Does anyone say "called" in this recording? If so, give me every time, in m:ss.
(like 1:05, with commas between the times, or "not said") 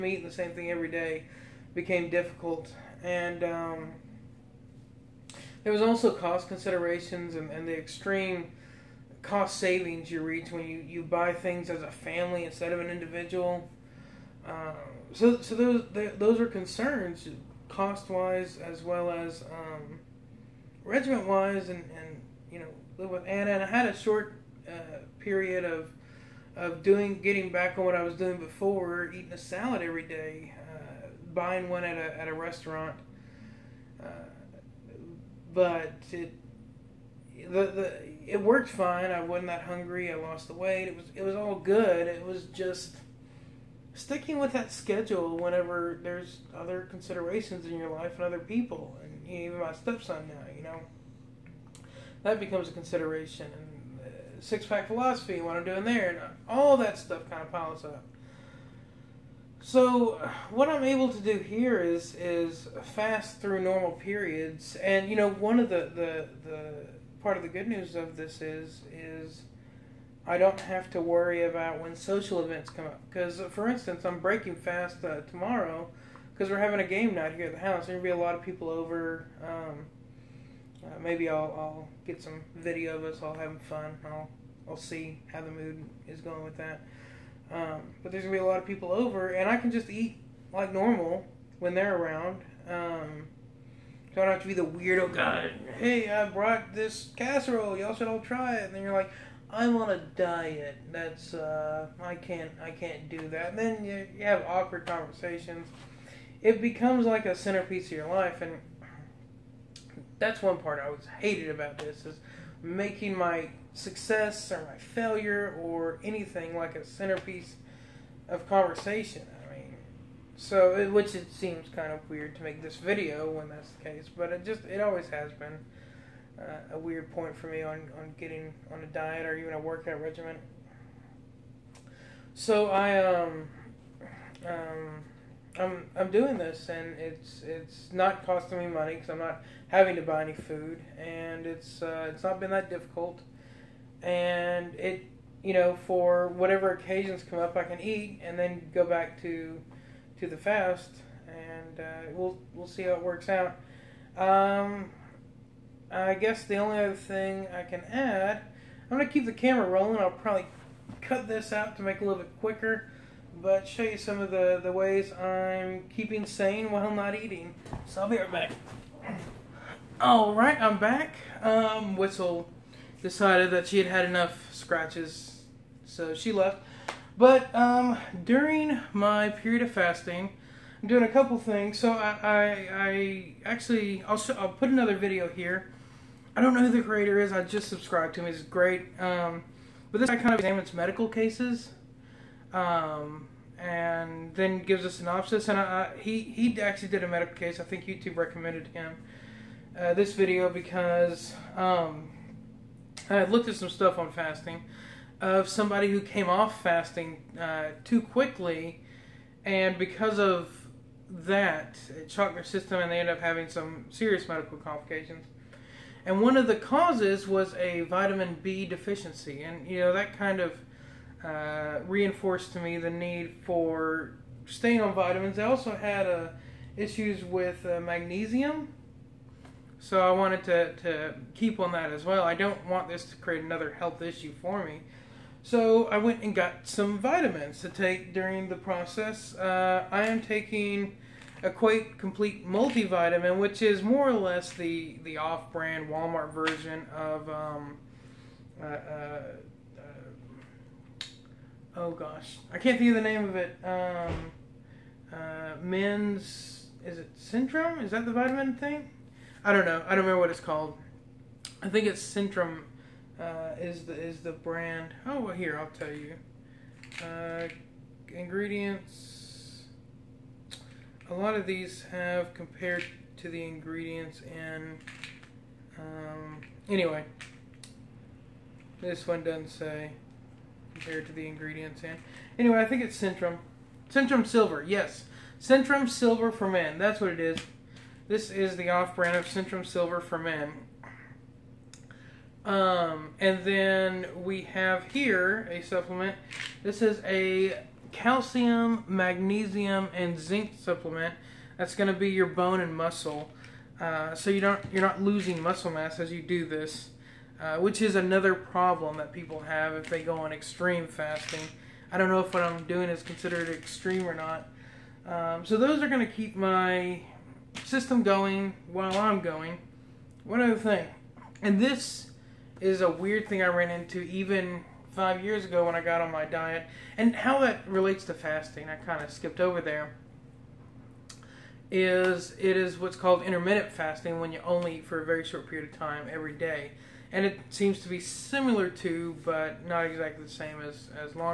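4:20, 5:32.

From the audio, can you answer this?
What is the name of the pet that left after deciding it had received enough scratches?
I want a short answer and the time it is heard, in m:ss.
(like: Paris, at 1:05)
Whistle, at 2:51.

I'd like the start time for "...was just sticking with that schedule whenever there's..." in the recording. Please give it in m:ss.
0:42.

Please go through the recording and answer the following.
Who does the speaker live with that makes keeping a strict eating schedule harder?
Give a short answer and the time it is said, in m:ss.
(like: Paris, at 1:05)
Anna, at 0:23.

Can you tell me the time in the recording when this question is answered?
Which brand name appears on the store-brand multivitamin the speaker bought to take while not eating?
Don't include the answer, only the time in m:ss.
4:01.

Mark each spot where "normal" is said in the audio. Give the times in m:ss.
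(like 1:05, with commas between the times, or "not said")
1:03, 1:30.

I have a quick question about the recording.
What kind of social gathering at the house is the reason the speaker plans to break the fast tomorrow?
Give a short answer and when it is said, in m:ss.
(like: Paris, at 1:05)
game night, at 1:16.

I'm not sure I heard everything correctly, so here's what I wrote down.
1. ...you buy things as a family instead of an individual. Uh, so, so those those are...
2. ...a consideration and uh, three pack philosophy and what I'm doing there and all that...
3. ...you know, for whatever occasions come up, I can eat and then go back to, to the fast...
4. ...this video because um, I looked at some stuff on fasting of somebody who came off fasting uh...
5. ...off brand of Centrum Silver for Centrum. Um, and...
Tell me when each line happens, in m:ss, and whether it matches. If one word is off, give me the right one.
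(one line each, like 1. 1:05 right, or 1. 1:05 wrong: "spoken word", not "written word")
1. 0:10 right
2. 0:52 wrong: "six", not "three"
3. 2:25 right
4. 3:19 right
5. 4:48 wrong: "Men", not "Centrum".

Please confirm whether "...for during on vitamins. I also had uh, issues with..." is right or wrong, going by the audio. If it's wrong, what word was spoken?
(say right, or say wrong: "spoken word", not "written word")
wrong: "staying", not "during".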